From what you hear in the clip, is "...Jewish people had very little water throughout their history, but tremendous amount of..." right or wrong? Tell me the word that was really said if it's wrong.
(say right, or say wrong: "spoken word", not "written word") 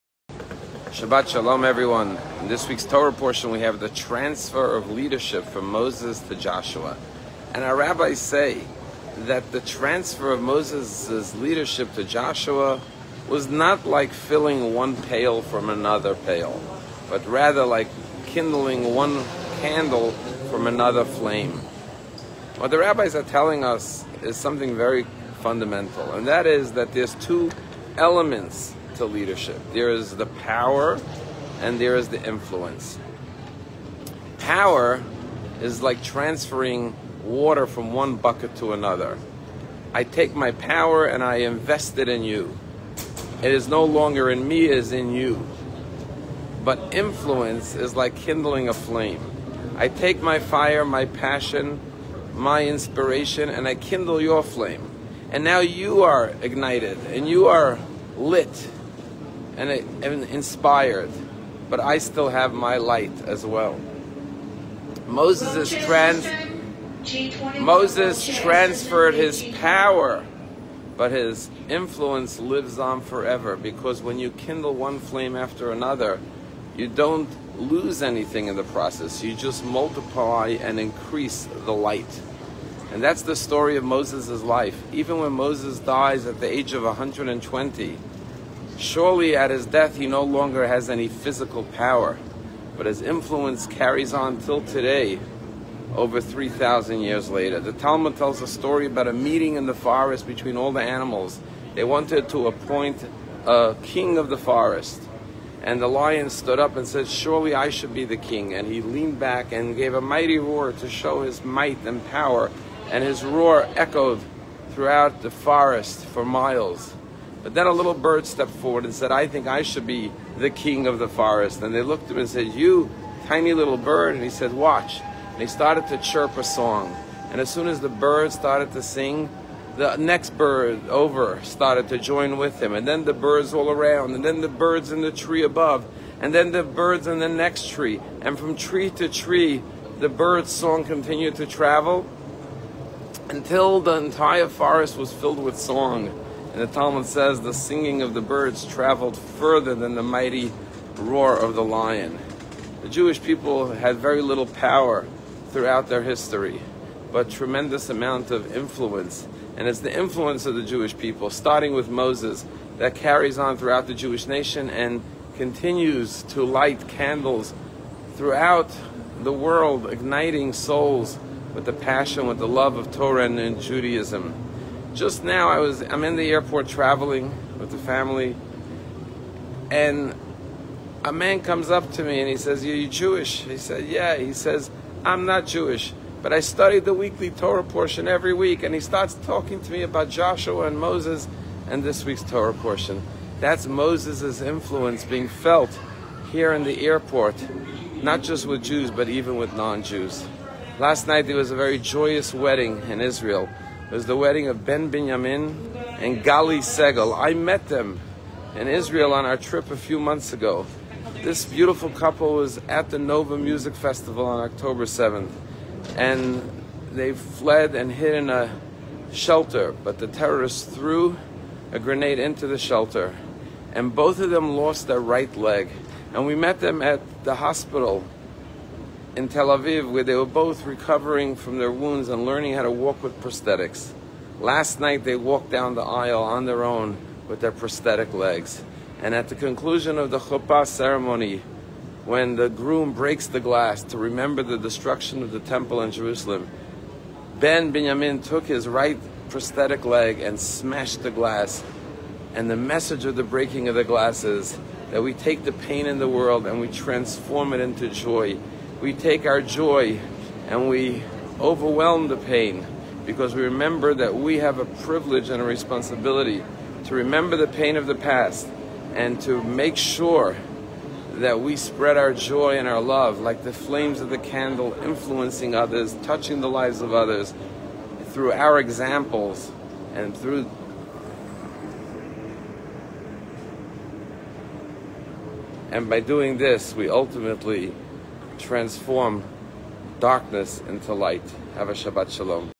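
wrong: "power", not "water".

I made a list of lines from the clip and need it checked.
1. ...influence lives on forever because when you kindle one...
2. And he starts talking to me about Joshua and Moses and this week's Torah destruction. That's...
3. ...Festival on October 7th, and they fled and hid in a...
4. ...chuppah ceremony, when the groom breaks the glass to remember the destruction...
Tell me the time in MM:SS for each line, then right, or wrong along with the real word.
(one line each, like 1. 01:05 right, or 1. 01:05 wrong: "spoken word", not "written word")
1. 01:11 right
2. 03:08 wrong: "portion", not "destruction"
3. 03:33 right
4. 04:00 right.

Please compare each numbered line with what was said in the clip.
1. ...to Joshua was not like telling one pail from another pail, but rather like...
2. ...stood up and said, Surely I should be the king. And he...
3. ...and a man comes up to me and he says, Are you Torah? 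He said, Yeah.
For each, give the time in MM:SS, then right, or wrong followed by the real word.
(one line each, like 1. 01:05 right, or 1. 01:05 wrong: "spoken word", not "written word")
1. 00:11 wrong: "filling", not "telling"
2. 01:46 right
3. 02:59 wrong: "Jewish", not "Torah".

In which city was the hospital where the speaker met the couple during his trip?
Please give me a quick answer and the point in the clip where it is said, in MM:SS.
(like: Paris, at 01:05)
Tel Aviv, at 03:49.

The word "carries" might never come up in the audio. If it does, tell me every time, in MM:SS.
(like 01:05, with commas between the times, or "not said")
01:33, 02:42.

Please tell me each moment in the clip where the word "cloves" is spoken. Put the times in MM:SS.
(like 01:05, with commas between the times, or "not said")
not said.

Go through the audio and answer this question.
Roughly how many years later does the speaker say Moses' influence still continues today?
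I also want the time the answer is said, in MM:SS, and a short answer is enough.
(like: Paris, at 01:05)
over 3000 years, at 01:35.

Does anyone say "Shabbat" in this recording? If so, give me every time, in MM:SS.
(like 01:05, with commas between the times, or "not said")
00:00, 04:51.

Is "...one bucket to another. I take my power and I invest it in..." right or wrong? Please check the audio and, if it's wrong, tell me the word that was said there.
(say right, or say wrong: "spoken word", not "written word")
right.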